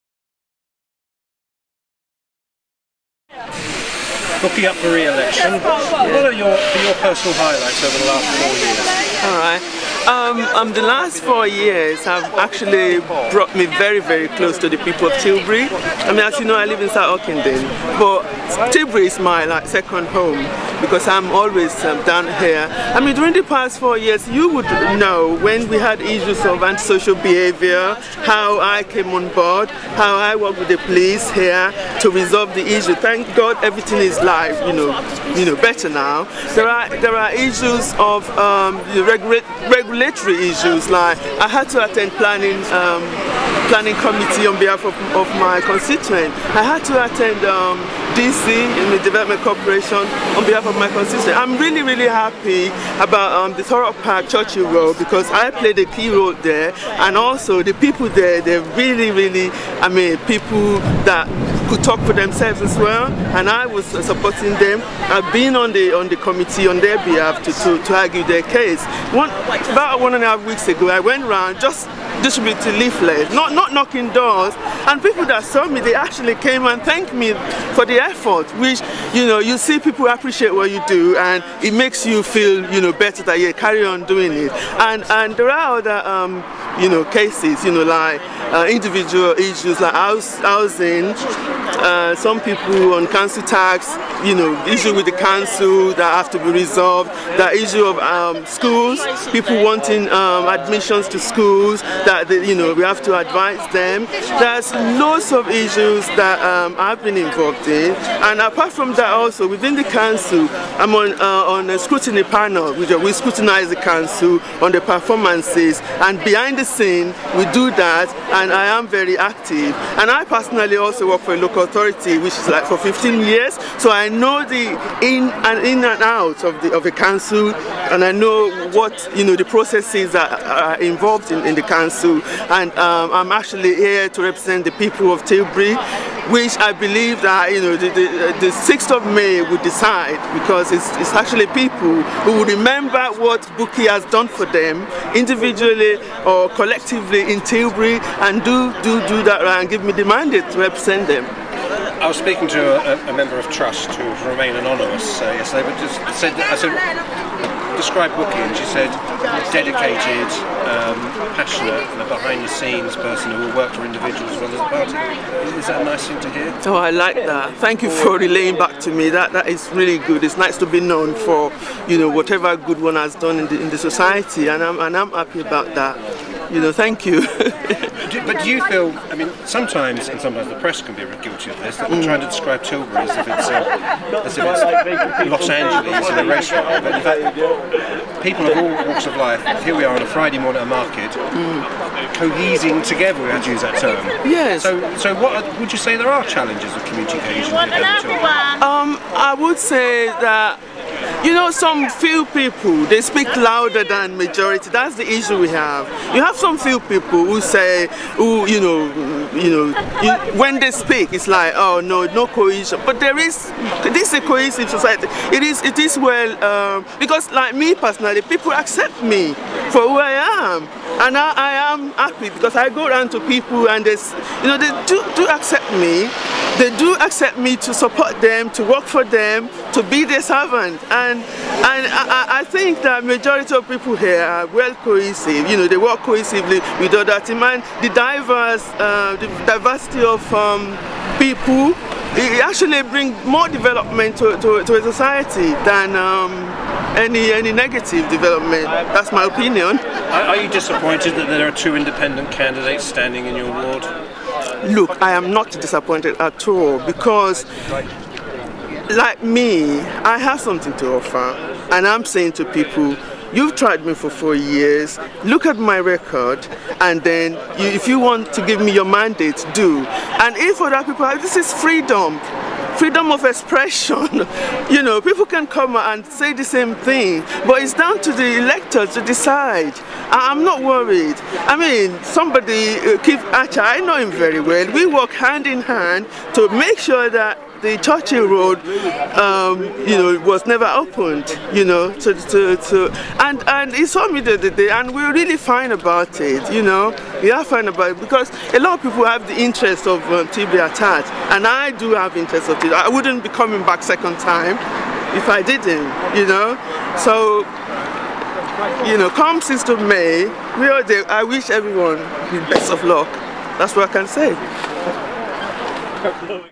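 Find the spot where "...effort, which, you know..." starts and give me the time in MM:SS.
01:18.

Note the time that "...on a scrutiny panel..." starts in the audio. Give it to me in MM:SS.
01:51.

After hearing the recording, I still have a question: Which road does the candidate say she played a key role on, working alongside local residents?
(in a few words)
Thurrock Park Churchill Road.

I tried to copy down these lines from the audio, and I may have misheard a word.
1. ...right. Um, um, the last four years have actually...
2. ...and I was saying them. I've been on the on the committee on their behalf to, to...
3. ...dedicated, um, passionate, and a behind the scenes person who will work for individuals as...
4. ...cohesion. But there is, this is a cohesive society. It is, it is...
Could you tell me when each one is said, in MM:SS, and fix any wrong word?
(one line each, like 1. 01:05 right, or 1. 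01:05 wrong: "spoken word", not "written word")
1. 00:09 right
2. 01:03 wrong: "supporting", not "saying"
3. 02:39 right
4. 03:32 right.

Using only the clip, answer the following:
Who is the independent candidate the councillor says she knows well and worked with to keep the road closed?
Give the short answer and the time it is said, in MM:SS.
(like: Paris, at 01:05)
Keith Archer, at 04:43.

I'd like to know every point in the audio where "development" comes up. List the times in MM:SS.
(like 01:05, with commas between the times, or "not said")
00:49, 04:03, 04:08.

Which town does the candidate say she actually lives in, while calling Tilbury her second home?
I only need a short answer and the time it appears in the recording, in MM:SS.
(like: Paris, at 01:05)
South Ockendon, at 00:16.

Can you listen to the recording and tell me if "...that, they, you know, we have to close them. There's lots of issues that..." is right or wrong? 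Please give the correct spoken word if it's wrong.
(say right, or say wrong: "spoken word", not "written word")
wrong: "advise", not "close".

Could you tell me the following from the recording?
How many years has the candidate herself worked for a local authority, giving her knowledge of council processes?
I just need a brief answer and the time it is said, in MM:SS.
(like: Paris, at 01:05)
15, at 02:02.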